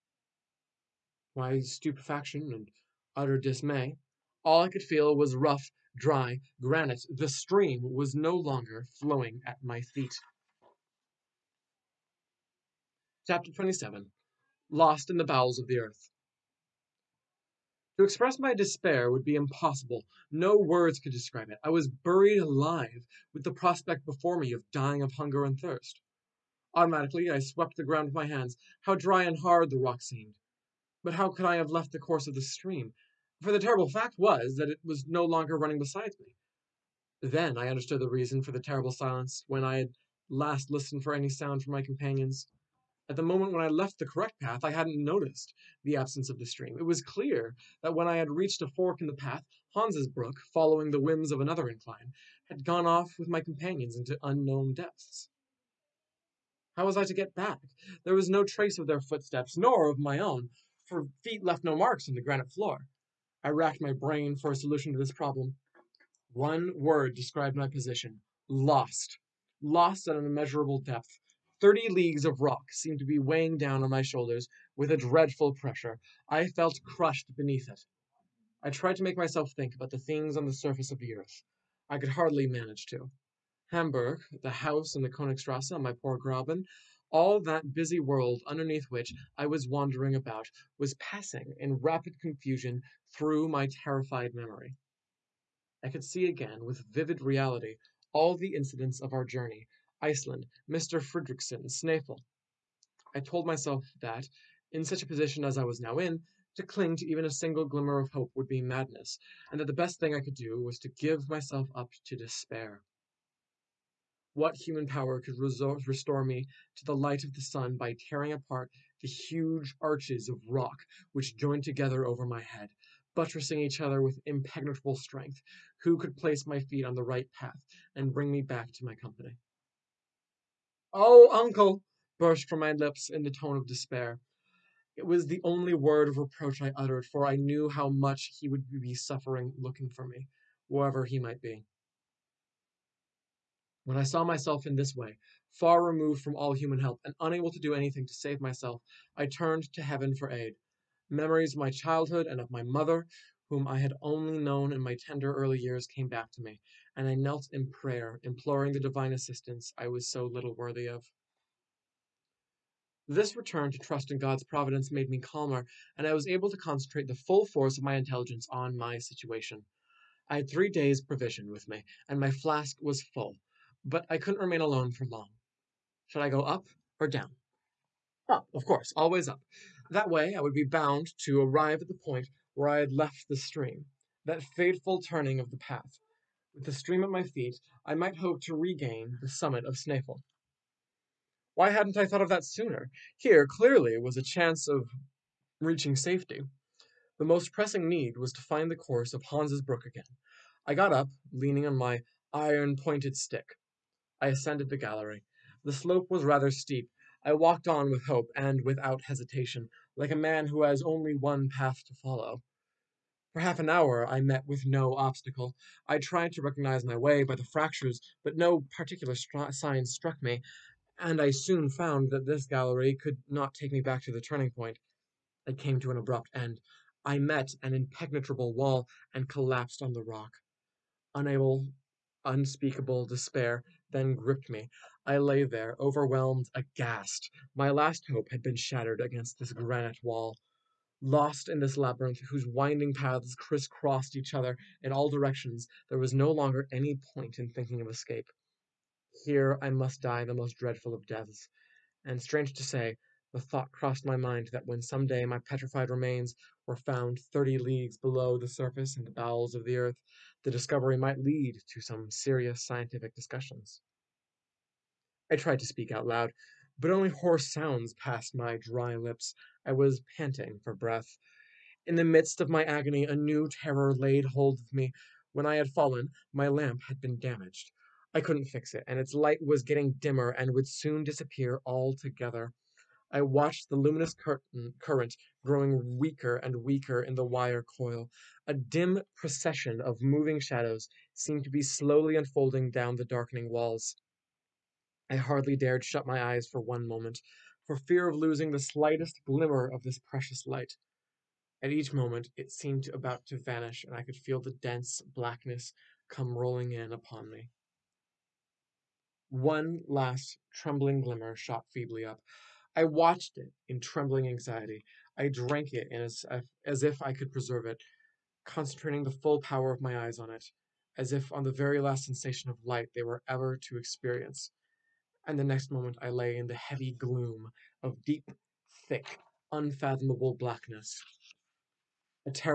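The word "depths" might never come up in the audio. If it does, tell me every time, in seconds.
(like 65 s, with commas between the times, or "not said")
54 s, 70 s.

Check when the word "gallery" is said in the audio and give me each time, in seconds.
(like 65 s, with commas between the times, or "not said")
204 s, 222 s.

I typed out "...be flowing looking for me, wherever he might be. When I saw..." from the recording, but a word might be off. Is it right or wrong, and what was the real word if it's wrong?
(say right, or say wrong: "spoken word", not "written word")
wrong: "suffering", not "flowing".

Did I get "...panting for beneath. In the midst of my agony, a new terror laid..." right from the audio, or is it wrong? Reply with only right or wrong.
wrong.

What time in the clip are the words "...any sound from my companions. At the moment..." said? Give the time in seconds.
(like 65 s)
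41 s.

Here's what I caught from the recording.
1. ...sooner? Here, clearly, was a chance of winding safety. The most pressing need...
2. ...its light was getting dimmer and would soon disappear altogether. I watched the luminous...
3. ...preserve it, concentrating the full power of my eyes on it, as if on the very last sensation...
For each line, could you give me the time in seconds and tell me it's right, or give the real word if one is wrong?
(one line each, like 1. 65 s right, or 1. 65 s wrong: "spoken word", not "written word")
1. 192 s wrong: "reaching", not "winding"
2. 278 s right
3. 317 s right.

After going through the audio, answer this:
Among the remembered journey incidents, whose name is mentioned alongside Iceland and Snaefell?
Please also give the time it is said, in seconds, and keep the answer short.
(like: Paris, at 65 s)
Mr. Fredriksson, at 100 s.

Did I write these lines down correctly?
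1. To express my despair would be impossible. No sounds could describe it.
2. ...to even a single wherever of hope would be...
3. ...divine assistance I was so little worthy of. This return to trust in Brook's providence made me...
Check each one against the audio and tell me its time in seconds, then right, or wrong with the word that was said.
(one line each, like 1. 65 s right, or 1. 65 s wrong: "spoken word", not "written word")
1. 17 s wrong: "words", not "sounds"
2. 106 s wrong: "glimmer", not "wherever"
3. 158 s wrong: "God", not "Brook".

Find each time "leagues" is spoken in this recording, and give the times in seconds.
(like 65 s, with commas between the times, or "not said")
71 s, 257 s.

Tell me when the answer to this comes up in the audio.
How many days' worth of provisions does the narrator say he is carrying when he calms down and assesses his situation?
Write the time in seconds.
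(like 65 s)
170 s.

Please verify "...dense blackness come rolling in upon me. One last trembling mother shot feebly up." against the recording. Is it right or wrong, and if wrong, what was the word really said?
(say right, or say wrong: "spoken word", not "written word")
wrong: "glimmer", not "mother".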